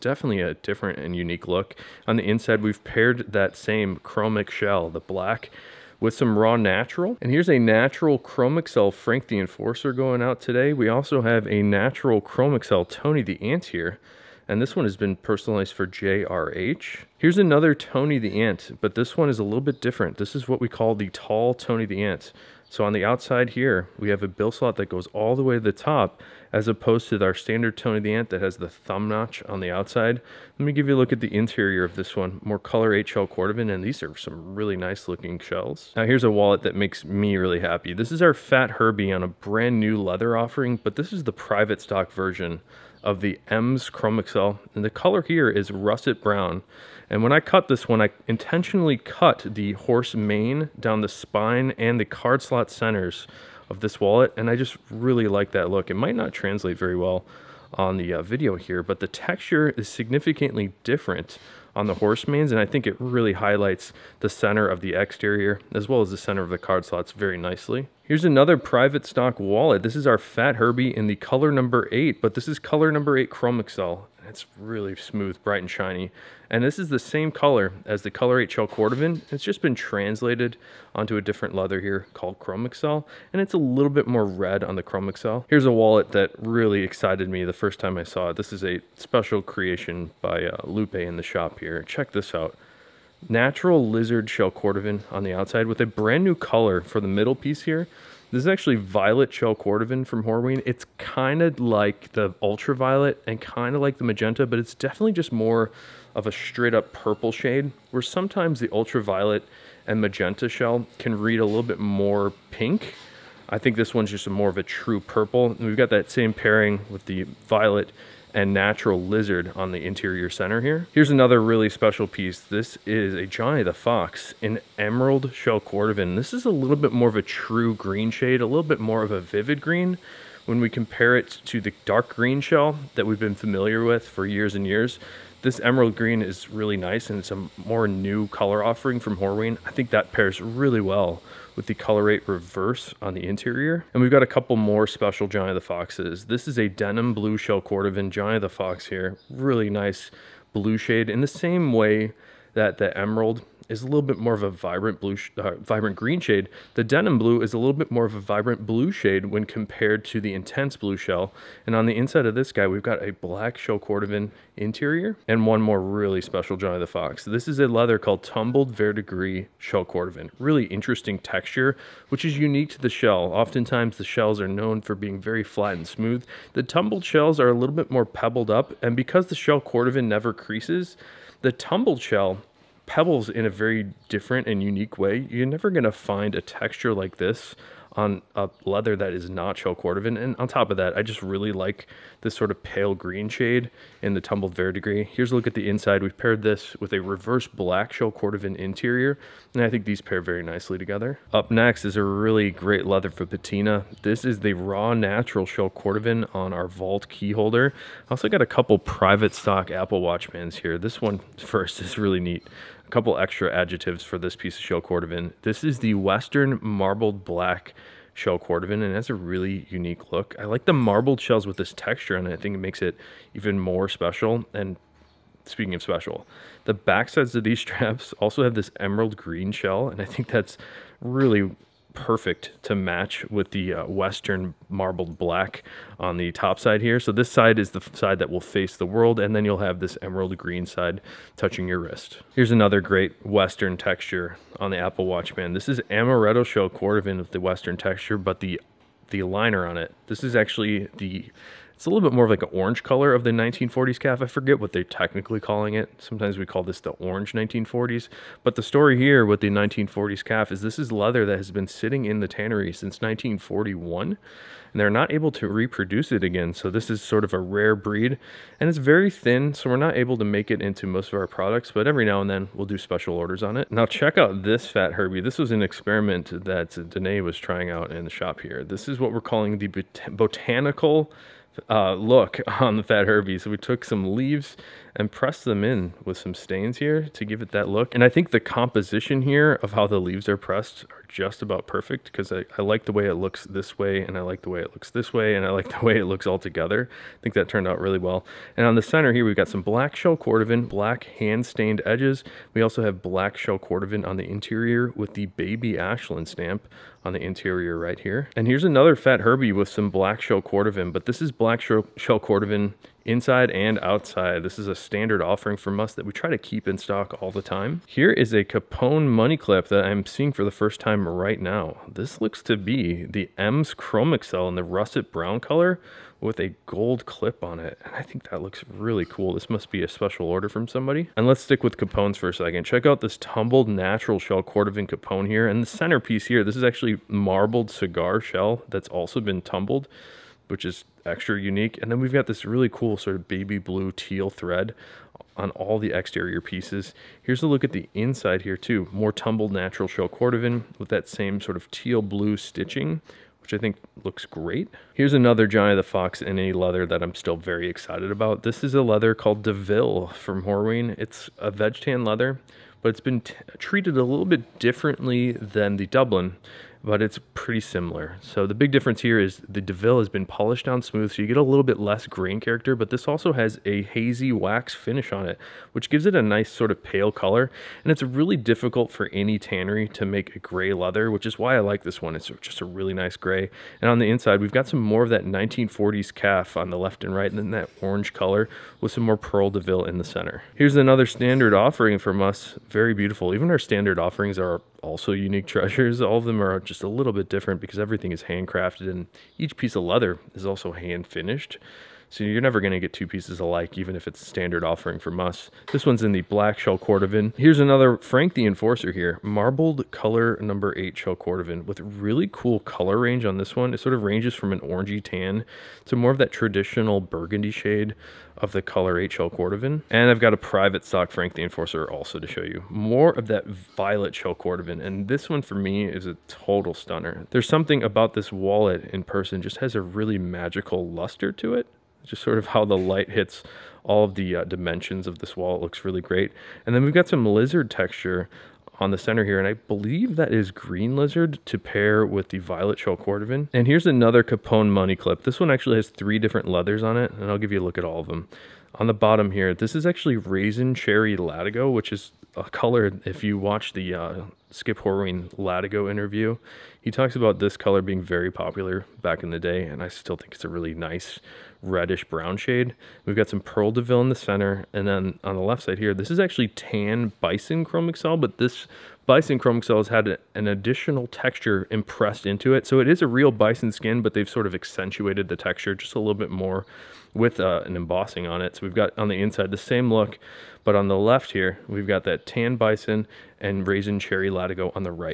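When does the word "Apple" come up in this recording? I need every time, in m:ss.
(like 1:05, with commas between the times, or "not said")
3:29, 4:04.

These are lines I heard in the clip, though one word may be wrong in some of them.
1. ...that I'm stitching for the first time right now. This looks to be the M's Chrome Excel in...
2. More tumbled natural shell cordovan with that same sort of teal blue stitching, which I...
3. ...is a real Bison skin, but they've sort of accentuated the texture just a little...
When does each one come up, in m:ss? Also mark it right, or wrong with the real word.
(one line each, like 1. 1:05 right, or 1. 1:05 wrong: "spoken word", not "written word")
1. 5:19 wrong: "seeing", not "stitching"
2. 5:48 right
3. 7:52 right.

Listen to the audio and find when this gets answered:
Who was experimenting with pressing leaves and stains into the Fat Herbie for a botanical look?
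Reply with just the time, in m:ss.
4:36.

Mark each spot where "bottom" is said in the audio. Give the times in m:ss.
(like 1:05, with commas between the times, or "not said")
7:28.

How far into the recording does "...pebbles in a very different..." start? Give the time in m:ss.
3:02.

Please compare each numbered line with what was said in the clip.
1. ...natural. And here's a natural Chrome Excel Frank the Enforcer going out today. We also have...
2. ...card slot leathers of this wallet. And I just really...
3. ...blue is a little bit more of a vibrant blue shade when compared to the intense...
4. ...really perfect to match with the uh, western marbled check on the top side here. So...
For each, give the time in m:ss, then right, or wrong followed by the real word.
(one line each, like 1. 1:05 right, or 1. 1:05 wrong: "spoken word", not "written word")
1. 0:06 right
2. 0:52 wrong: "centers", not "leathers"
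3. 2:37 right
4. 3:50 wrong: "black", not "check".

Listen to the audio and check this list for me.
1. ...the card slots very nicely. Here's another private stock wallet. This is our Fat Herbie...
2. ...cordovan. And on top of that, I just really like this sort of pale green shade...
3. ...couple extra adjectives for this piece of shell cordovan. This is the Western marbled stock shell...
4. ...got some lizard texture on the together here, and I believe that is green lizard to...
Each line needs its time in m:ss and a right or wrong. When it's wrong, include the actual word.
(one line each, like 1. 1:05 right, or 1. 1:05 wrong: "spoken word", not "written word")
1. 1:06 right
2. 3:09 right
3. 3:32 wrong: "black", not "stock"
4. 7:16 wrong: "center", not "together".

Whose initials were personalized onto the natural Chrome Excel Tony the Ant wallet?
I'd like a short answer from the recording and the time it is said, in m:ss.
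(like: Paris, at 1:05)
JRH, at 0:15.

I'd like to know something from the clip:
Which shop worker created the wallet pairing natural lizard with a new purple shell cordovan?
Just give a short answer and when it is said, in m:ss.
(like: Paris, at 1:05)
Lupe, at 1:30.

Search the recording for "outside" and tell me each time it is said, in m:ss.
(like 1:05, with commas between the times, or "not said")
0:23, 0:29, 1:35, 5:13.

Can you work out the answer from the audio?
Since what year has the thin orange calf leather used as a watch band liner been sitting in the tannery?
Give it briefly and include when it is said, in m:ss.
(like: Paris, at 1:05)
1941, at 4:22.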